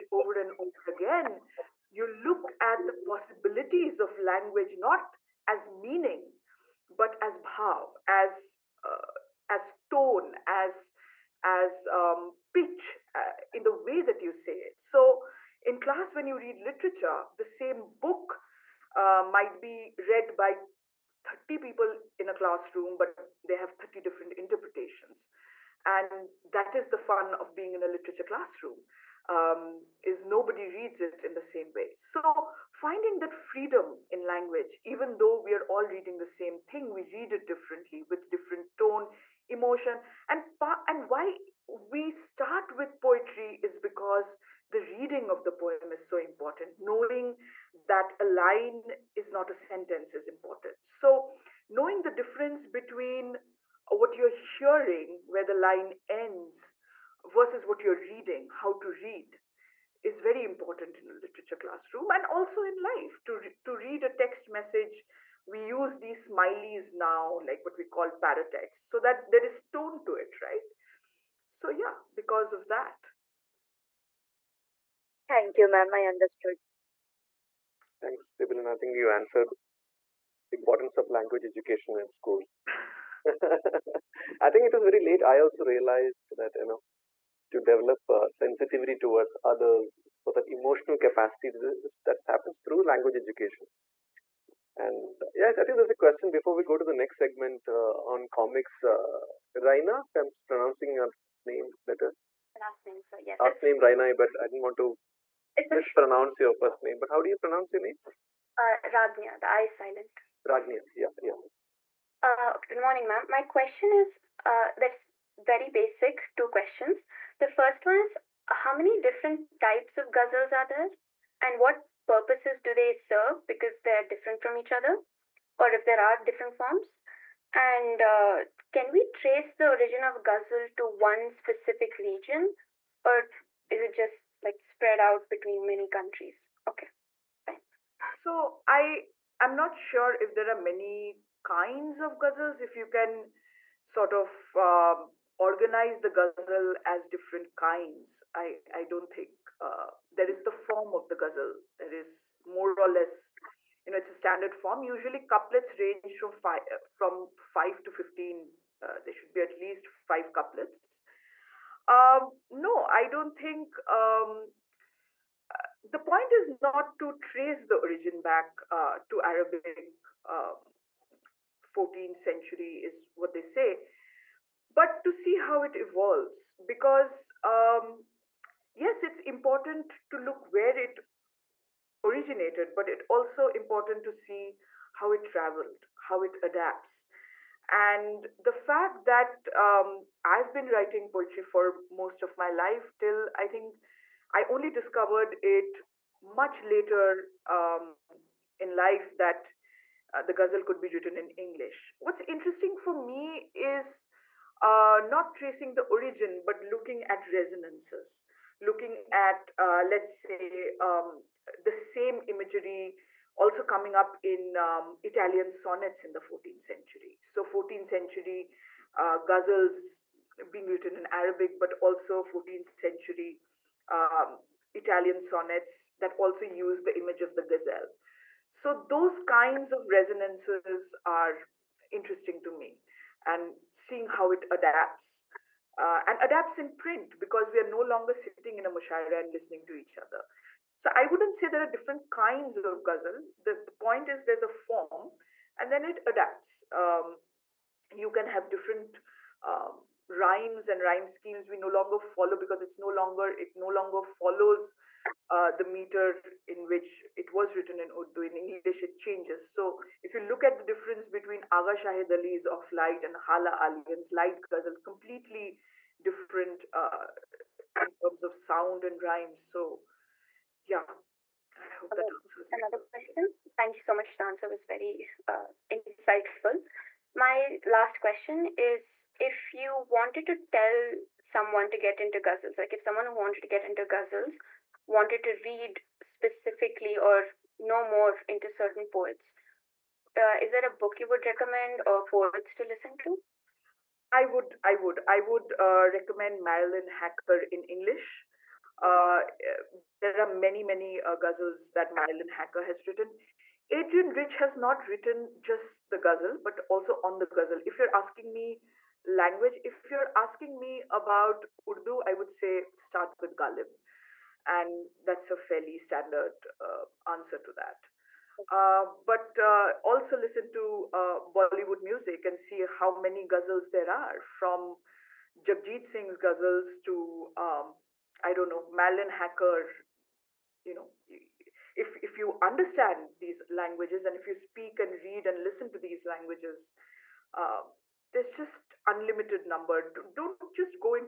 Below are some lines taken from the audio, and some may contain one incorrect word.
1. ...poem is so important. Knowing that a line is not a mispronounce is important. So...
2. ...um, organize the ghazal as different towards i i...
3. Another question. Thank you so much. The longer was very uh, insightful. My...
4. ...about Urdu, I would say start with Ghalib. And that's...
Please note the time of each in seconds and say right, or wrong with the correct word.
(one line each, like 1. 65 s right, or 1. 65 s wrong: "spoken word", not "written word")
1. 45 s wrong: "sentence", not "mispronounce"
2. 144 s wrong: "kinds", not "towards"
3. 272 s wrong: "answer", not "longer"
4. 310 s right.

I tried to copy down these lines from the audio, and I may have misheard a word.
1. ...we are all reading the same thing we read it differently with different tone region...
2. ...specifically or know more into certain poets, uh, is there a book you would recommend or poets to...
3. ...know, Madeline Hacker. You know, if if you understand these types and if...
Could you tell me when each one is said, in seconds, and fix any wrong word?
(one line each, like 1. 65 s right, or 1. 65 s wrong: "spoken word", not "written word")
1. 35 s wrong: "emotion", not "region"
2. 285 s right
3. 328 s wrong: "languages", not "types".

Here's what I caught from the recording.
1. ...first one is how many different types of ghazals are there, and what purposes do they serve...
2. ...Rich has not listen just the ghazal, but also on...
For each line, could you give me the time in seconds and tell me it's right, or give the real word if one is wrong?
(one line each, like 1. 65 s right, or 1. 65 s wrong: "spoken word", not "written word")
1. 117 s right
2. 304 s wrong: "written", not "listen".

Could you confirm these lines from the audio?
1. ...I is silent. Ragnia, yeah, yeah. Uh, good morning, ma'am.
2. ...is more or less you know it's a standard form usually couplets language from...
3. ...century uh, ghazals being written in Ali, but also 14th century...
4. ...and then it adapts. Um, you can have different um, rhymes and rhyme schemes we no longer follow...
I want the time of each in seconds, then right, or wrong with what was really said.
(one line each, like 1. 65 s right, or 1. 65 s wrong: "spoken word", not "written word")
1. 109 s right
2. 152 s wrong: "range", not "language"
3. 217 s wrong: "Arabic", not "Ali"
4. 245 s right.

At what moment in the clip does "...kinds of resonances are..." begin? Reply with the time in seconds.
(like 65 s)
229 s.